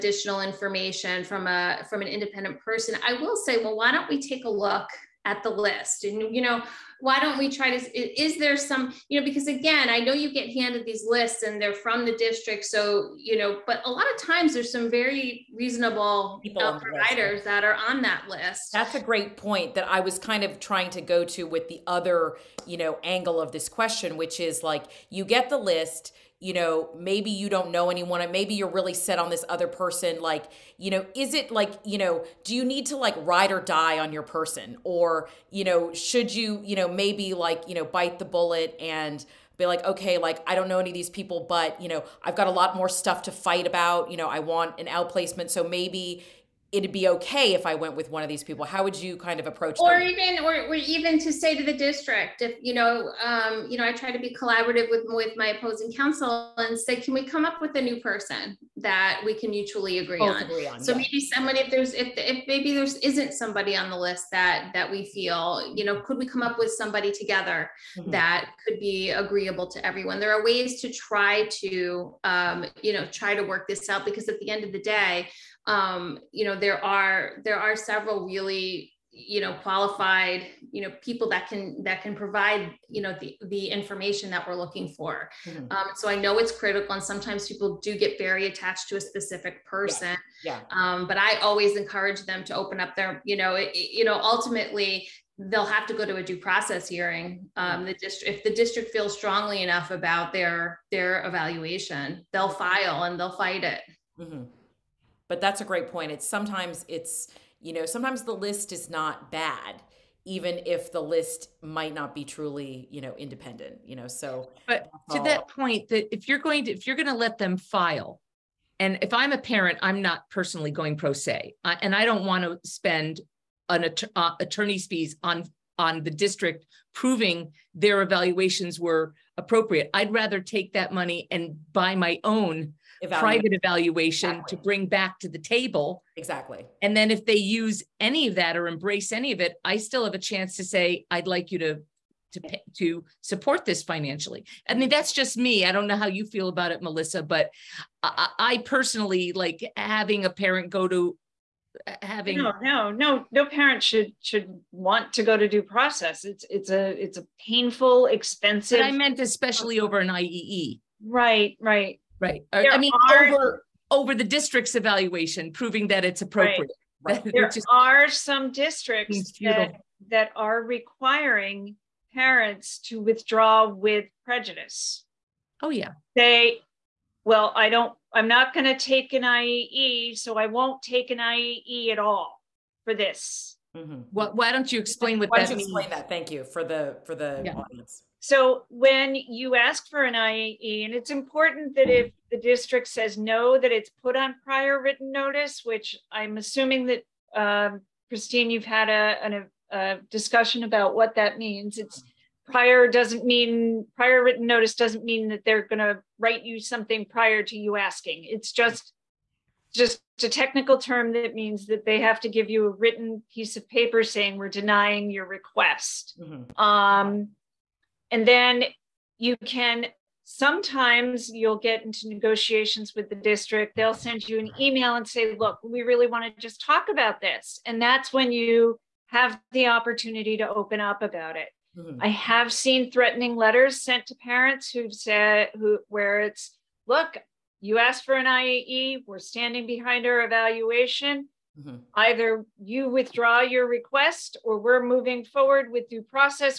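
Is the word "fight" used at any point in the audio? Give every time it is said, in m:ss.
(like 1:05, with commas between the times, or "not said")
0:43, 1:43.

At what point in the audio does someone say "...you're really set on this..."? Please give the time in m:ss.
0:28.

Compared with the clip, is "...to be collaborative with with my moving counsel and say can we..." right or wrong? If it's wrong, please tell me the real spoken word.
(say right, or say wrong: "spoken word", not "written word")
wrong: "opposing", not "moving".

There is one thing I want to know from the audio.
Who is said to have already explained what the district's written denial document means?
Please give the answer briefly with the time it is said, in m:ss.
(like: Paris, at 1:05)
Christine, at 3:18.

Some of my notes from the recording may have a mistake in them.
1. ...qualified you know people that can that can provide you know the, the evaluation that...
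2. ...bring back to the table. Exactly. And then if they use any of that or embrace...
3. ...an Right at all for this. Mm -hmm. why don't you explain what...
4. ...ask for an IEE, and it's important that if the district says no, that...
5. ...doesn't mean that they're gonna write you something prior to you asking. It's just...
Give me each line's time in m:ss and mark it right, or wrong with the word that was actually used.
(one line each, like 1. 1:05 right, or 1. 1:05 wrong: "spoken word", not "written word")
1. 1:19 wrong: "information", not "evaluation"
2. 2:14 right
3. 3:01 wrong: "IEE", not "Right"
4. 3:09 right
5. 3:24 right.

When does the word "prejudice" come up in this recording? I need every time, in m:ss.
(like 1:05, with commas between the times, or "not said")
2:54.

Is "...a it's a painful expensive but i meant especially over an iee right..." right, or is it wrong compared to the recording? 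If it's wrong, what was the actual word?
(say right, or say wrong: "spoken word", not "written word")
right.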